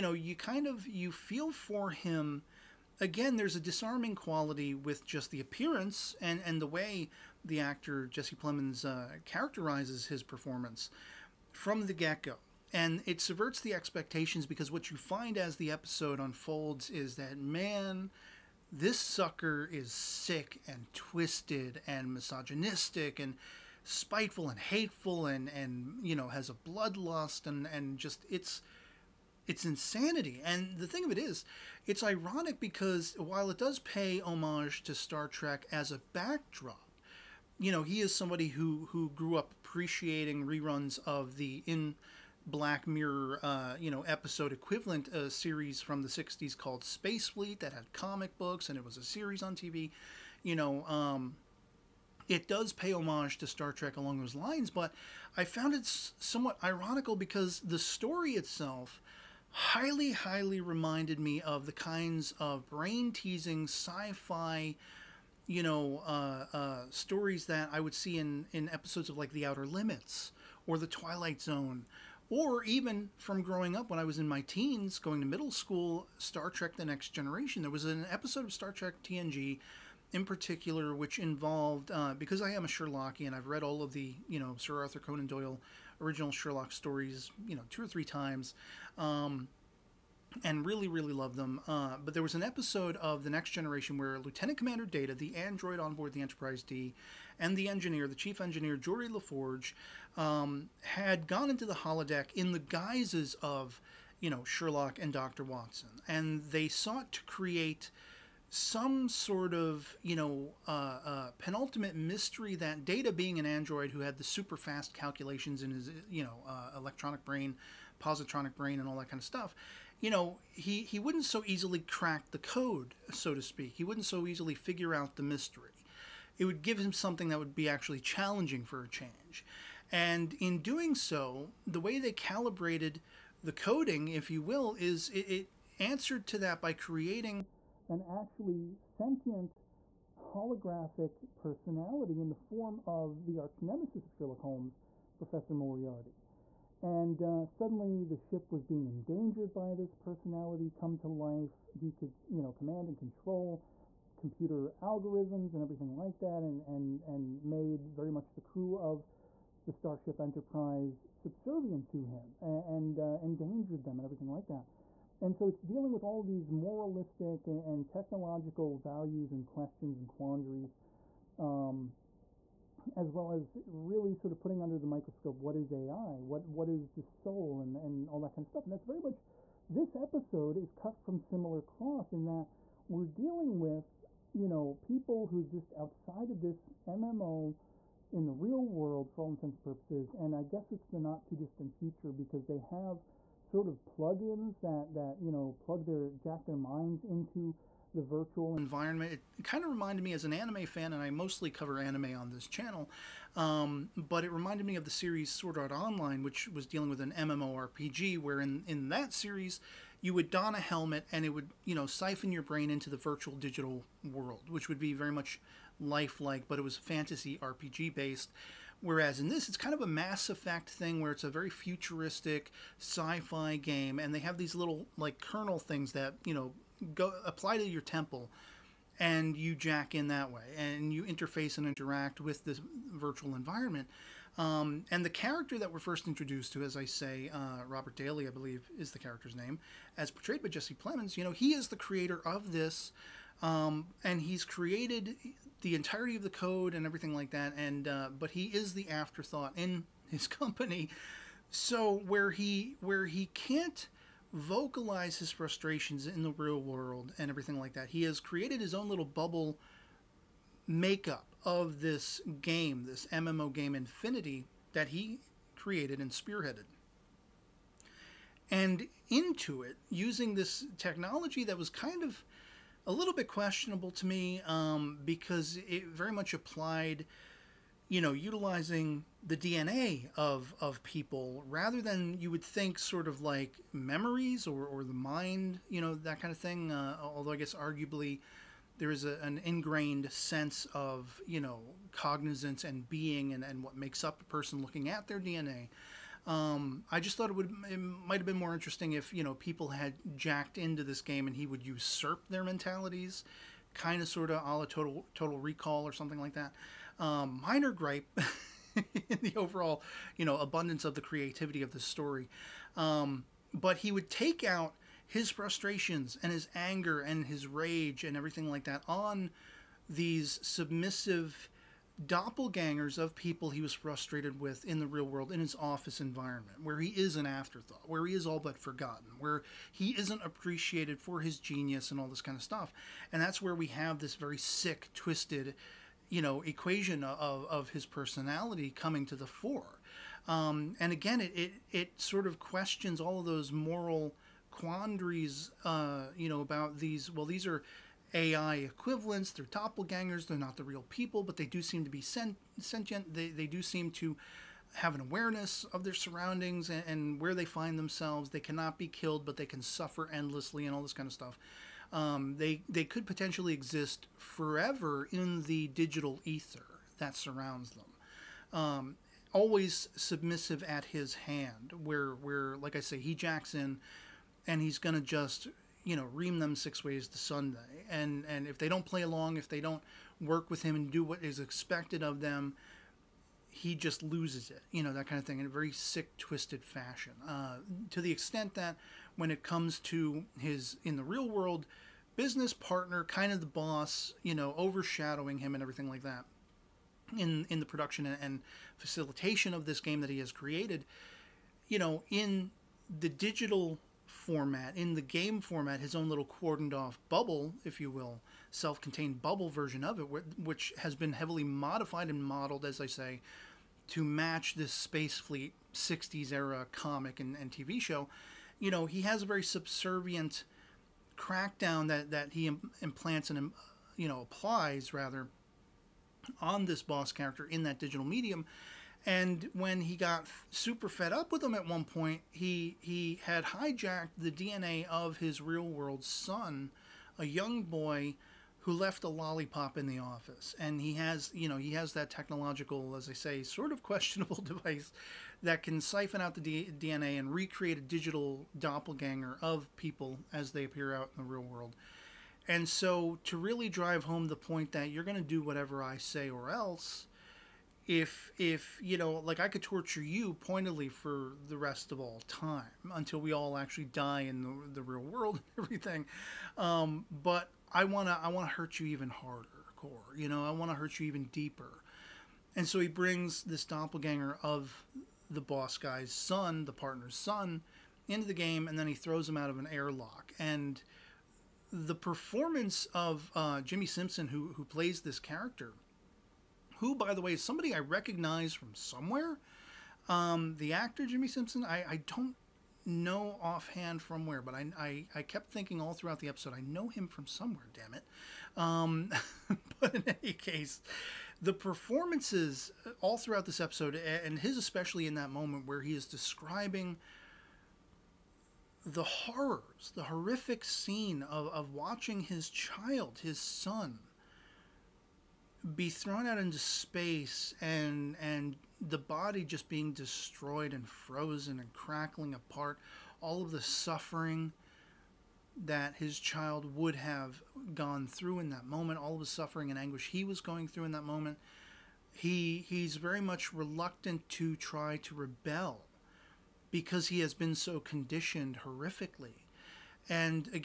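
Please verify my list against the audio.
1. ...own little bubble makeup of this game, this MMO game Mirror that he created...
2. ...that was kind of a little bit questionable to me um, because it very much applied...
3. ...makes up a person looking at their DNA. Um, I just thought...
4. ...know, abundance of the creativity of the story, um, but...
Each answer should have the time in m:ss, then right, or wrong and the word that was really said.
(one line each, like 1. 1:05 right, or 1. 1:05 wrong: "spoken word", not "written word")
1. 4:18 wrong: "Infinity", not "Mirror"
2. 4:31 right
3. 4:53 right
4. 5:10 right.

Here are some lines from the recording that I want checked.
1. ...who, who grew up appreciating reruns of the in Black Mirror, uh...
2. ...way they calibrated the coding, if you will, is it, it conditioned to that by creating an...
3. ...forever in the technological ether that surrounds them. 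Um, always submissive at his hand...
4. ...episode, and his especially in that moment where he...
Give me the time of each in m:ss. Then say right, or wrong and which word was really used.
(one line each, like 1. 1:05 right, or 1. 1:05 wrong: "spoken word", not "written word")
1. 0:38 right
2. 2:11 wrong: "answered", not "conditioned"
3. 6:04 wrong: "digital", not "technological"
4. 8:23 right.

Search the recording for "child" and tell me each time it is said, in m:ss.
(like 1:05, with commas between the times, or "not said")
8:32, 8:46.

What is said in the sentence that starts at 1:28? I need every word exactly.
Um, and really, really loved them.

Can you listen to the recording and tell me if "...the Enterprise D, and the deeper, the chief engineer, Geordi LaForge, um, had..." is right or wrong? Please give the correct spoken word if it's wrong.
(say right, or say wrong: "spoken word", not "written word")
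wrong: "engineer", not "deeper".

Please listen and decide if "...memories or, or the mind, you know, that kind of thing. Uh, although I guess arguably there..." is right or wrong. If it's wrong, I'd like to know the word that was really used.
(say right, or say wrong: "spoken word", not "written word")
right.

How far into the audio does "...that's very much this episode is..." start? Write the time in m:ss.
2:58.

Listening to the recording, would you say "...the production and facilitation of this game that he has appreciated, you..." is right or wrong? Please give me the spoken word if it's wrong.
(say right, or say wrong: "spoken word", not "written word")
wrong: "created", not "appreciated".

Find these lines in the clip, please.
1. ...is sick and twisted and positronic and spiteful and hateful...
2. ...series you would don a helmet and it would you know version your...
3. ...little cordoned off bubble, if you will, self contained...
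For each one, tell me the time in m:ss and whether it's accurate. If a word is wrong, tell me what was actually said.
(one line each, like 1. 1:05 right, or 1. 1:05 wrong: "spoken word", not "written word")
1. 0:19 wrong: "misogynistic", not "positronic"
2. 3:29 wrong: "siphon", not "version"
3. 6:46 right.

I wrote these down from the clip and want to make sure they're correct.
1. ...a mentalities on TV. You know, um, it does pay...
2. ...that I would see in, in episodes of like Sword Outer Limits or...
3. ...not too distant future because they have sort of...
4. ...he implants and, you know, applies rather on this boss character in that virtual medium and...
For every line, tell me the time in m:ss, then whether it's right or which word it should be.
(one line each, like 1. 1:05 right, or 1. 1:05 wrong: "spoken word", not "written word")
1. 0:48 wrong: "series", not "mentalities"
2. 1:07 wrong: "The", not "Sword"
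3. 3:10 right
4. 7:02 wrong: "digital", not "virtual".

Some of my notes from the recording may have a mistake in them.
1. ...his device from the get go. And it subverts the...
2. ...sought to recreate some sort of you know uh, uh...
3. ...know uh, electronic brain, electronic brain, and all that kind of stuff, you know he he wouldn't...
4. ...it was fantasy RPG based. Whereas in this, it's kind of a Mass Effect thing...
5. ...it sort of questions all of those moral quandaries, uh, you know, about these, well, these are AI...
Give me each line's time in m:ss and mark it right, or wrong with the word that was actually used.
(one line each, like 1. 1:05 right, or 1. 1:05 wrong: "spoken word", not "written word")
1. 0:10 wrong: "performance", not "device"
2. 1:46 wrong: "create", not "recreate"
3. 1:56 wrong: "positronic", not "electronic"
4. 3:36 right
5. 5:41 right.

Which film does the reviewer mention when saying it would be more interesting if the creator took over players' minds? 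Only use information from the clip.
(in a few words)
Total Recall.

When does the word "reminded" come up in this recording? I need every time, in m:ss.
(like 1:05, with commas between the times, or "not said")
1:00, 3:19, 3:24.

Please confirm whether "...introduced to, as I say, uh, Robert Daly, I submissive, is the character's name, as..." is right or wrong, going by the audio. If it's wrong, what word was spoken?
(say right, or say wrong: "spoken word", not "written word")
wrong: "believe", not "submissive".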